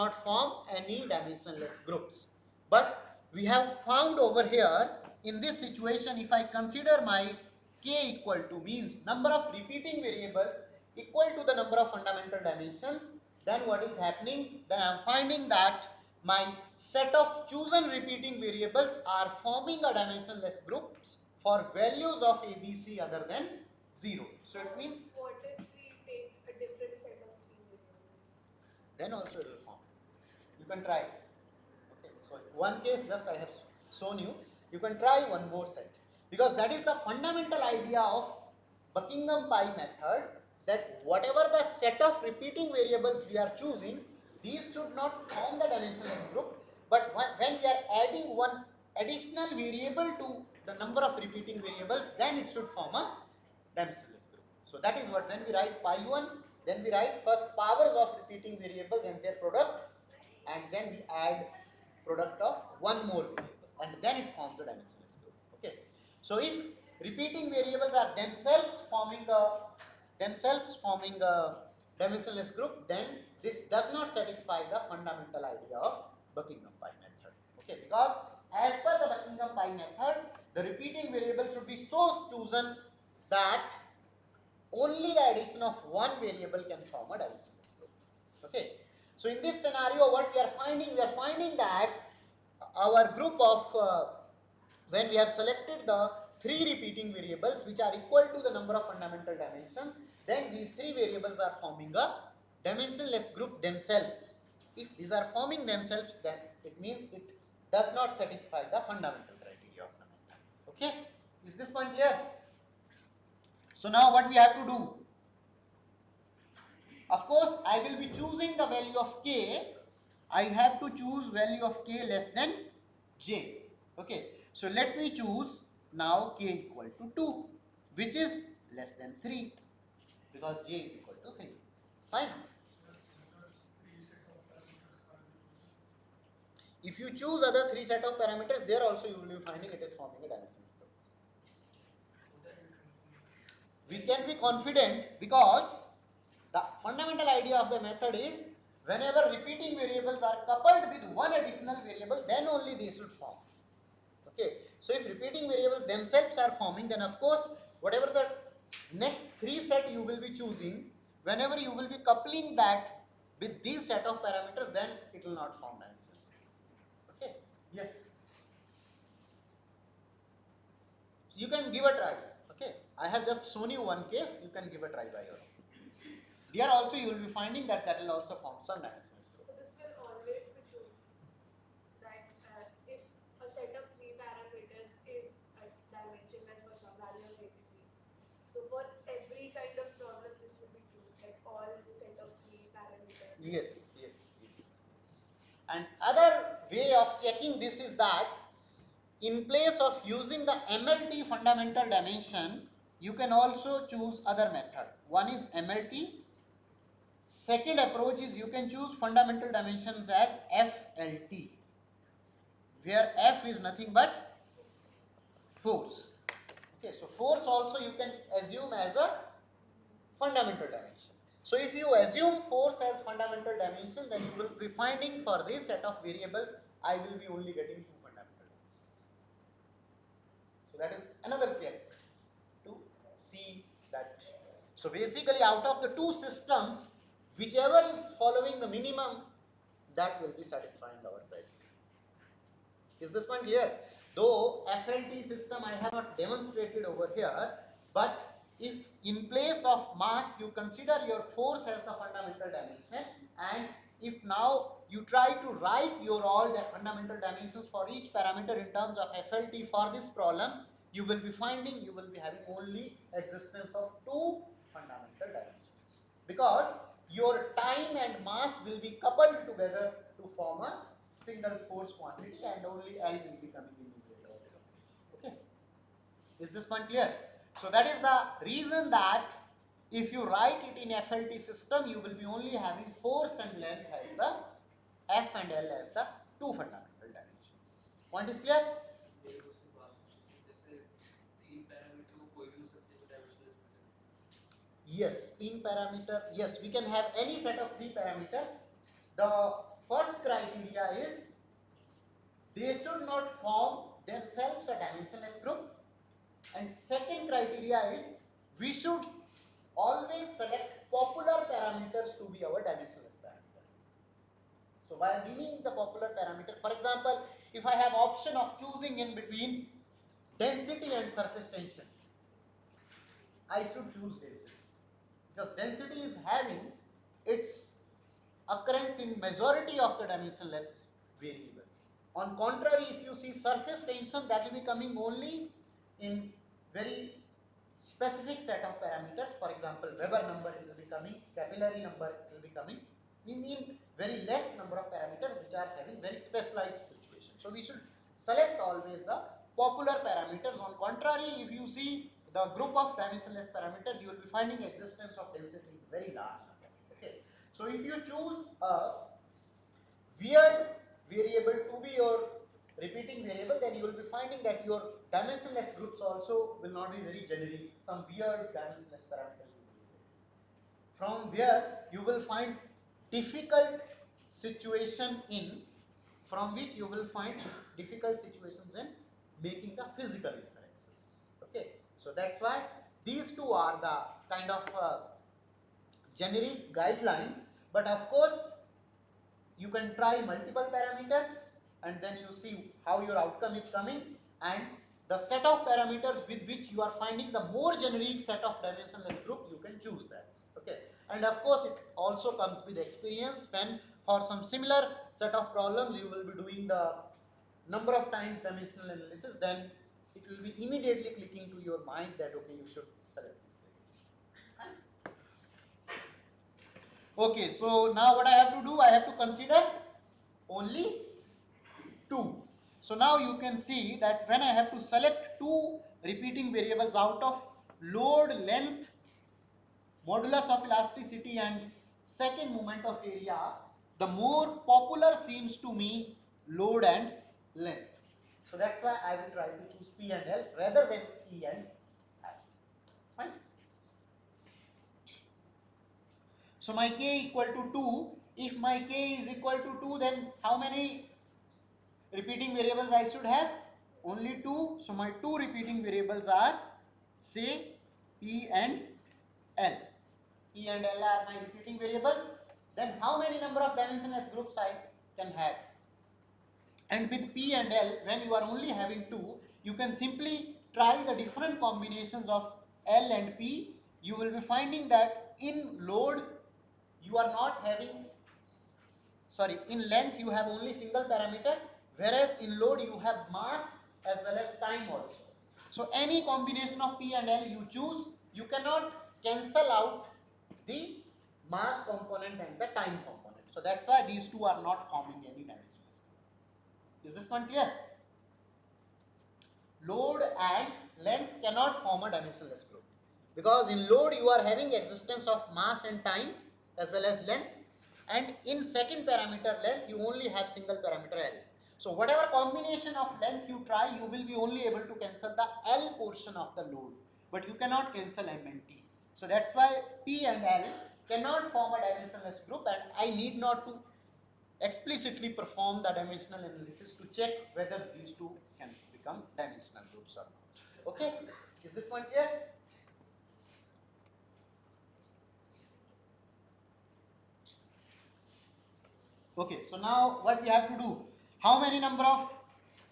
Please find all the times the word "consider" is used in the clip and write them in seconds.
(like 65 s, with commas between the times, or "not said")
6 s, 250 s, 419 s.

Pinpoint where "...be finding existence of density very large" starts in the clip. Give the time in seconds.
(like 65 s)
354 s.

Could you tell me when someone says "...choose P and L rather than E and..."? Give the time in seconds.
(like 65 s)
439 s.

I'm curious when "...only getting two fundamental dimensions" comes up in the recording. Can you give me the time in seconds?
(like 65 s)
227 s.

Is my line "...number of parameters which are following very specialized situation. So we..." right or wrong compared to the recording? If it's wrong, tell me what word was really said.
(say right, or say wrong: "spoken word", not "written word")
wrong: "having", not "following".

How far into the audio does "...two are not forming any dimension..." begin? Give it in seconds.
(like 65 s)
494 s.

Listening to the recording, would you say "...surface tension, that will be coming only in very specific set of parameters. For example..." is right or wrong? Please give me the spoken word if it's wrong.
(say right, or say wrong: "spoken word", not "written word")
right.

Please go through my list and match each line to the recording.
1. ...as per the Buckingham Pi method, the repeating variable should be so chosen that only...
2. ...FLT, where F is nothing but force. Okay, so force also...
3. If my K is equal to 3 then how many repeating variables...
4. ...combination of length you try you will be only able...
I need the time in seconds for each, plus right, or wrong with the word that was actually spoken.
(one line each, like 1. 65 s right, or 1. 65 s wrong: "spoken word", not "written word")
1. 78 s right
2. 210 s right
3. 448 s wrong: "2", not "3"
4. 512 s right.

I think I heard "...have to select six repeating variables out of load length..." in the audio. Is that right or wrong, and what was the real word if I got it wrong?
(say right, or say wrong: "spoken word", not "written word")
wrong: "two", not "six".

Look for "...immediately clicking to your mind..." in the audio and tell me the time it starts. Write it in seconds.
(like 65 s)
410 s.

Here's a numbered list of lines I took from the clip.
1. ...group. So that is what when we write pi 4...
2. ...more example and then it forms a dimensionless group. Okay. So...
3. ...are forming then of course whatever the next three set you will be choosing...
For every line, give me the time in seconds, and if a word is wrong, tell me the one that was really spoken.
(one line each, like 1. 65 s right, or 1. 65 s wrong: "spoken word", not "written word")
1. 53 s wrong: "1", not "4"
2. 63 s wrong: "variable", not "example"
3. 156 s right.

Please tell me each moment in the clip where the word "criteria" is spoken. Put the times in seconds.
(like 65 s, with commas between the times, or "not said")
109 s, 241 s, 300 s, 307 s.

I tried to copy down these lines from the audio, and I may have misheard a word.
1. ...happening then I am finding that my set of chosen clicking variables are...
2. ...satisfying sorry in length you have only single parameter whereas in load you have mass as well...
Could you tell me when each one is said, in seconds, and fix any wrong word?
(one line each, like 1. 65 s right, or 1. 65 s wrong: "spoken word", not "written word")
1. 13 s wrong: "repeating", not "clicking"
2. 477 s wrong: "having", not "satisfying".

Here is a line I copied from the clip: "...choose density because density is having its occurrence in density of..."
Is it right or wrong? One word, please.
wrong.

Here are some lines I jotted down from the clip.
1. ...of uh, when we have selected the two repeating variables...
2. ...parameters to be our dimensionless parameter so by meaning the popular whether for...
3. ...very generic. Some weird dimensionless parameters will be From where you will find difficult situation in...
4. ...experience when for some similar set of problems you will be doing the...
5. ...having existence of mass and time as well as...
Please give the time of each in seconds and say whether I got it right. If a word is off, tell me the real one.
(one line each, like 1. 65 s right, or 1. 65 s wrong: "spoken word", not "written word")
1. 93 s wrong: "three", not "two"
2. 311 s wrong: "parameter", not "whether"
3. 367 s right
4. 402 s right
5. 504 s right.